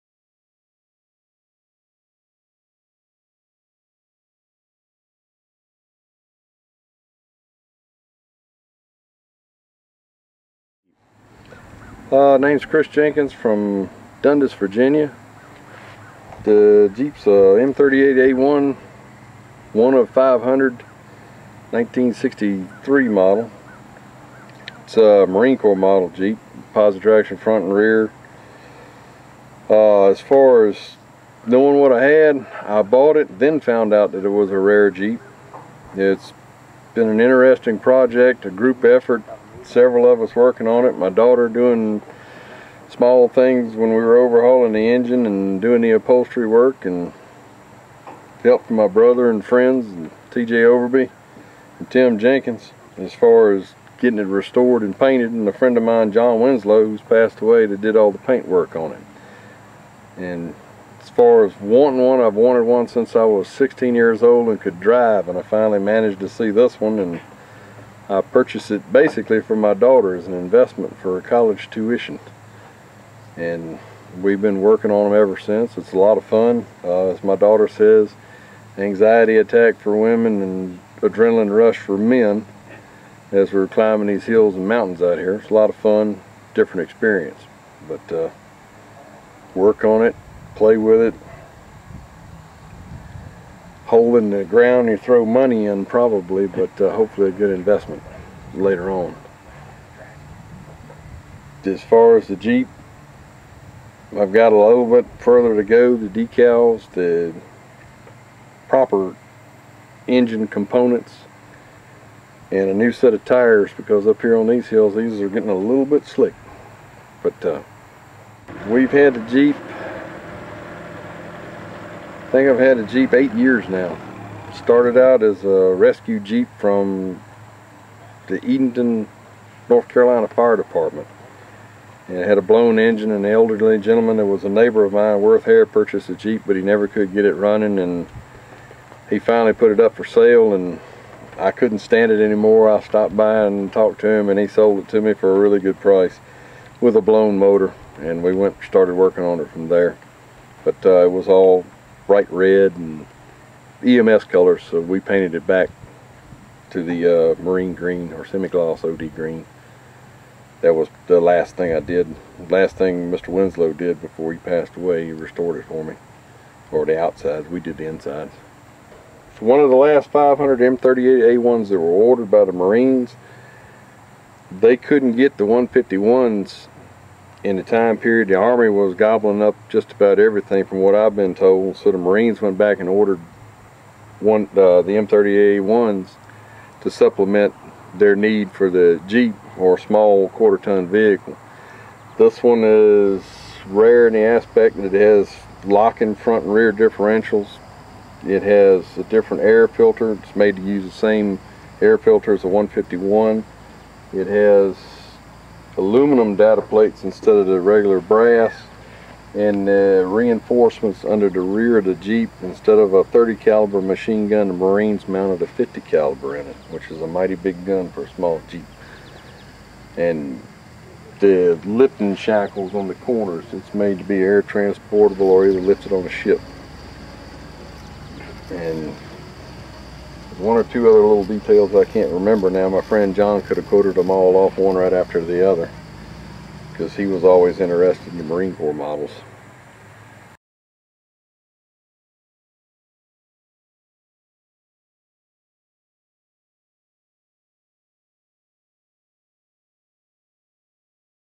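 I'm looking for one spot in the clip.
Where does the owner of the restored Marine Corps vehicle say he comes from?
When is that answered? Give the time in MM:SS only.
00:14.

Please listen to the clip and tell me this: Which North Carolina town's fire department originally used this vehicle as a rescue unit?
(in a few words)
Edenton.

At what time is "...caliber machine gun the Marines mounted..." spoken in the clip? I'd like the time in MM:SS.
03:33.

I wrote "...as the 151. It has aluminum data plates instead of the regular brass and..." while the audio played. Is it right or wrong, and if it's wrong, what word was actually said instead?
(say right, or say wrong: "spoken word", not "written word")
right.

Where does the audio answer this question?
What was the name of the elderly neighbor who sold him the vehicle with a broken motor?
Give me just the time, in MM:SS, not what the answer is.
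02:15.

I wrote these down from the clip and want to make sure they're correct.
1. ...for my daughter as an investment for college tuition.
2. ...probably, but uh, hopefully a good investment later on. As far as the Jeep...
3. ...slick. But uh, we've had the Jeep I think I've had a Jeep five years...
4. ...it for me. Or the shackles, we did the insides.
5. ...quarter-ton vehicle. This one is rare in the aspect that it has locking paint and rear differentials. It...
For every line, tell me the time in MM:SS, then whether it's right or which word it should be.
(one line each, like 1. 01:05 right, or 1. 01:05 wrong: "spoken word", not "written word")
1. 01:09 right
2. 01:35 right
3. 01:56 wrong: "eight", not "five"
4. 02:45 wrong: "outsides", not "shackles"
5. 03:10 wrong: "front", not "paint".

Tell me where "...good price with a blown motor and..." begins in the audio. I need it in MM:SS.
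02:25.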